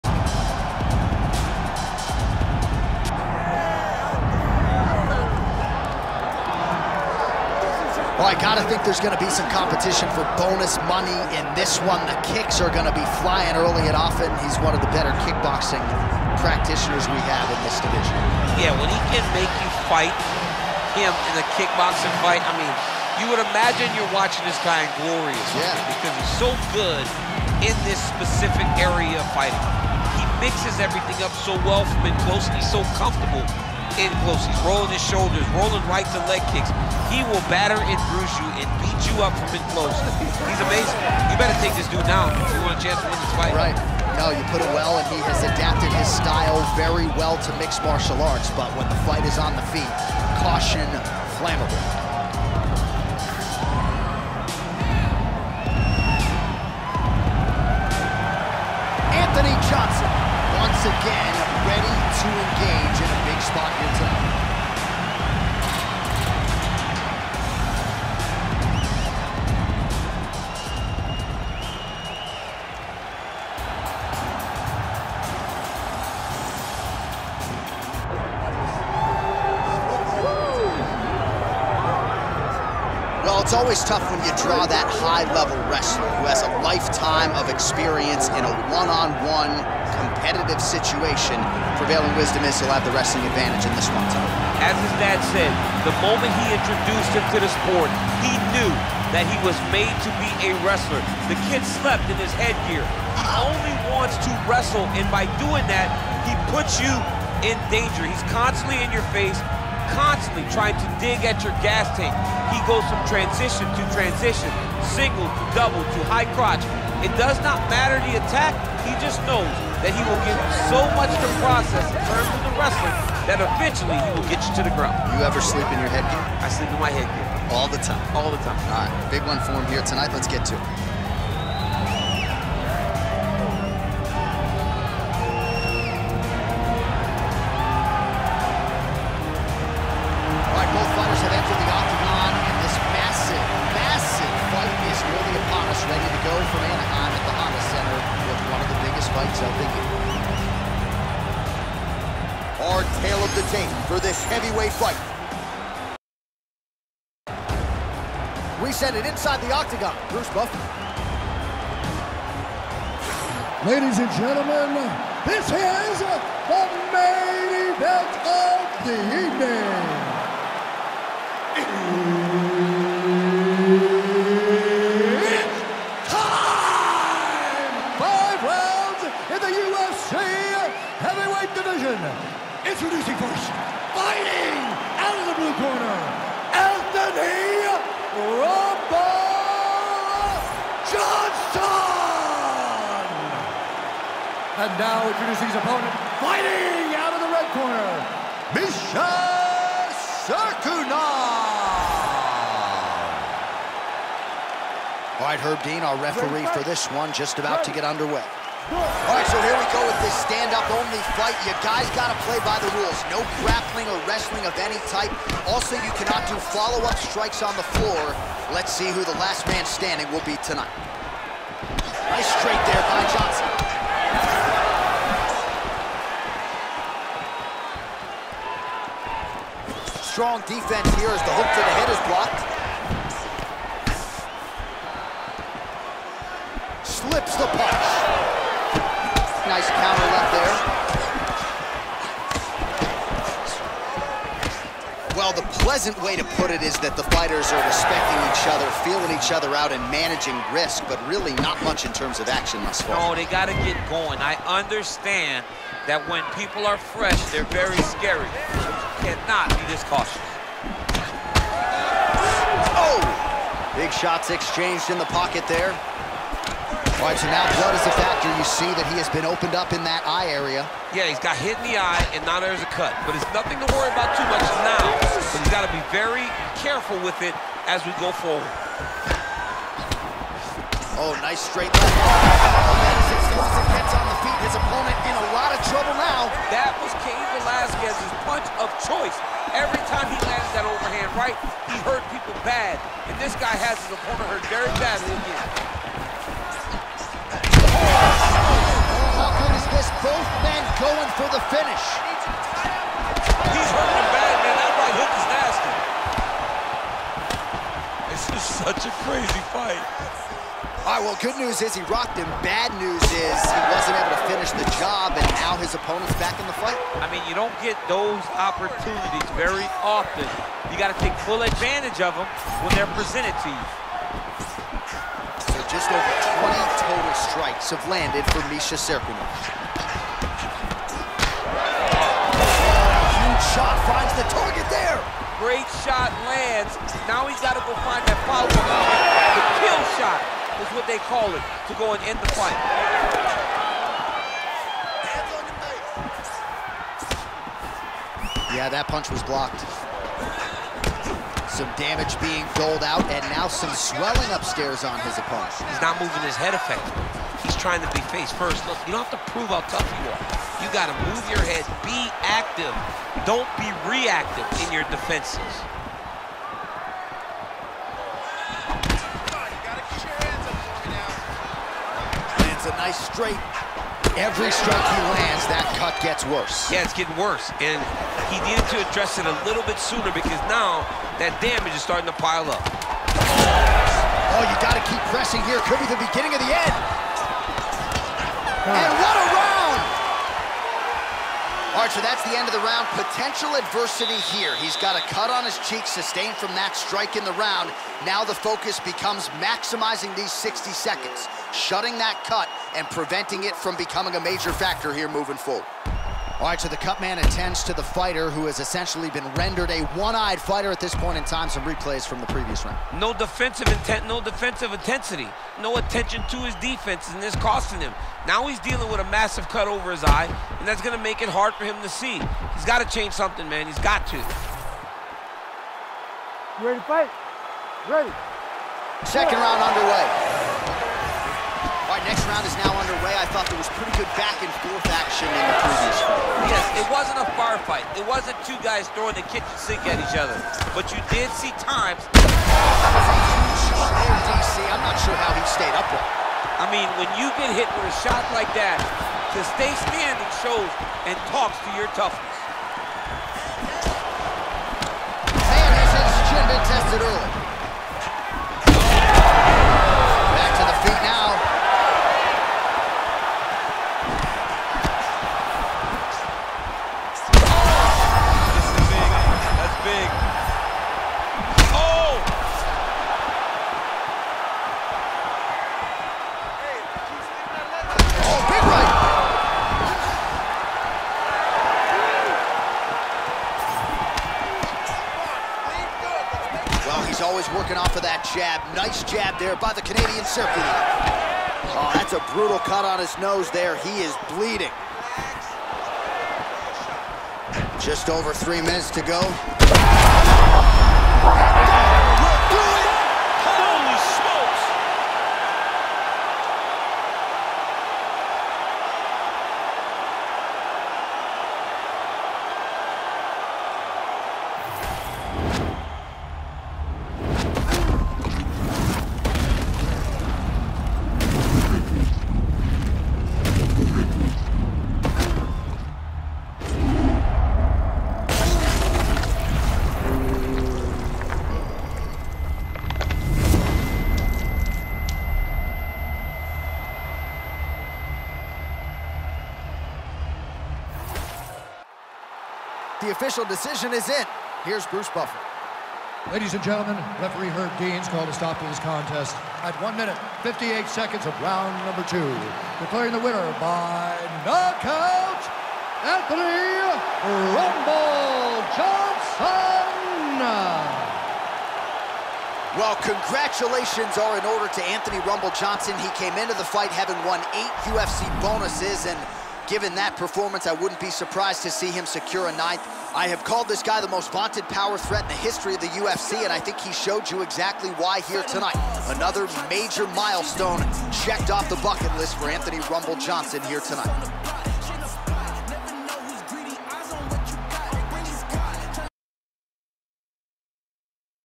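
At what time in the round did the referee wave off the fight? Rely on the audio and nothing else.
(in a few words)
1:58.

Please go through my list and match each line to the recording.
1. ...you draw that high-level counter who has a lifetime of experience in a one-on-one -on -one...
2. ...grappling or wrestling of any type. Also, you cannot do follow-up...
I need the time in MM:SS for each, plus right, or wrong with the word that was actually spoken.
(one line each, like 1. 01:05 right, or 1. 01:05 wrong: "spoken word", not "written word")
1. 01:24 wrong: "wrestler", not "counter"
2. 03:33 right.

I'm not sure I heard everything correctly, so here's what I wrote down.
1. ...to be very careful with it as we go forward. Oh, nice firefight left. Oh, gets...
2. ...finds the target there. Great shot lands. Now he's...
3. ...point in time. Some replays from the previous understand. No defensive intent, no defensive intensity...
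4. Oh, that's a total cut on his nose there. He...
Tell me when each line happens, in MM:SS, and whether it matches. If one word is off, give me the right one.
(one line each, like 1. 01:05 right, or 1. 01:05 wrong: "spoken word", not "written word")
1. 04:35 wrong: "straight", not "firefight"
2. 05:33 right
3. 06:50 wrong: "round", not "understand"
4. 08:11 wrong: "brutal", not "total".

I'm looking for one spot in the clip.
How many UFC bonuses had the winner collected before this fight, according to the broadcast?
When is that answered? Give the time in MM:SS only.
09:27.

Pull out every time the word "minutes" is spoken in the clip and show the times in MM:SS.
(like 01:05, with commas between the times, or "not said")
08:18, 09:09.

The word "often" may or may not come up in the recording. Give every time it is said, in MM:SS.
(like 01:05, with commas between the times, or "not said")
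00:13, 05:19.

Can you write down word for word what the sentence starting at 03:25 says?
All right, Herb Dean, our referee for this one, just about to get underway.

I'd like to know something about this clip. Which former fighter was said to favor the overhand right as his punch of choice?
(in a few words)
Cain Velasquez.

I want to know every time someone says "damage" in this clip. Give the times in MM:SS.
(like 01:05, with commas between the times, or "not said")
05:51, 06:21.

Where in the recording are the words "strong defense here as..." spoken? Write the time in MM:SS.
03:50.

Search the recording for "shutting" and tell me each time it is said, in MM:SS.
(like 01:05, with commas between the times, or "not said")
06:41.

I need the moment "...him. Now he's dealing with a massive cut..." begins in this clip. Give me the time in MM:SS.
06:57.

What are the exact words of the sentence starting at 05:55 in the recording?
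He's not moving his head effectively.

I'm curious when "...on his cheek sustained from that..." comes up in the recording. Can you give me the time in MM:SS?
06:35.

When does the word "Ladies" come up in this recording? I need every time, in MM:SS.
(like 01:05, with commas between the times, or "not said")
02:43, 09:06.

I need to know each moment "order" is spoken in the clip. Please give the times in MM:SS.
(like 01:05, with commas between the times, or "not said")
09:24.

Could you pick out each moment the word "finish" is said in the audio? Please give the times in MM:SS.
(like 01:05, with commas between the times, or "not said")
05:01, 05:14.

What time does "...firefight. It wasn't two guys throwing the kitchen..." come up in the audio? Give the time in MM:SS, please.
07:17.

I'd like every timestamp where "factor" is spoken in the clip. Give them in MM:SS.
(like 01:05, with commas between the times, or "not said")
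04:27, 06:44.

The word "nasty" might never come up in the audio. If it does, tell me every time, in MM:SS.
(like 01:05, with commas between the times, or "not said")
05:05.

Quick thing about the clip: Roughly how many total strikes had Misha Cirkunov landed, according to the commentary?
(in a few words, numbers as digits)
Just over 20.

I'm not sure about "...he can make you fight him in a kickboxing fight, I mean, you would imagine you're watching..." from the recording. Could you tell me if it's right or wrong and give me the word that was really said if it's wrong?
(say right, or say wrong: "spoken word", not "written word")
right.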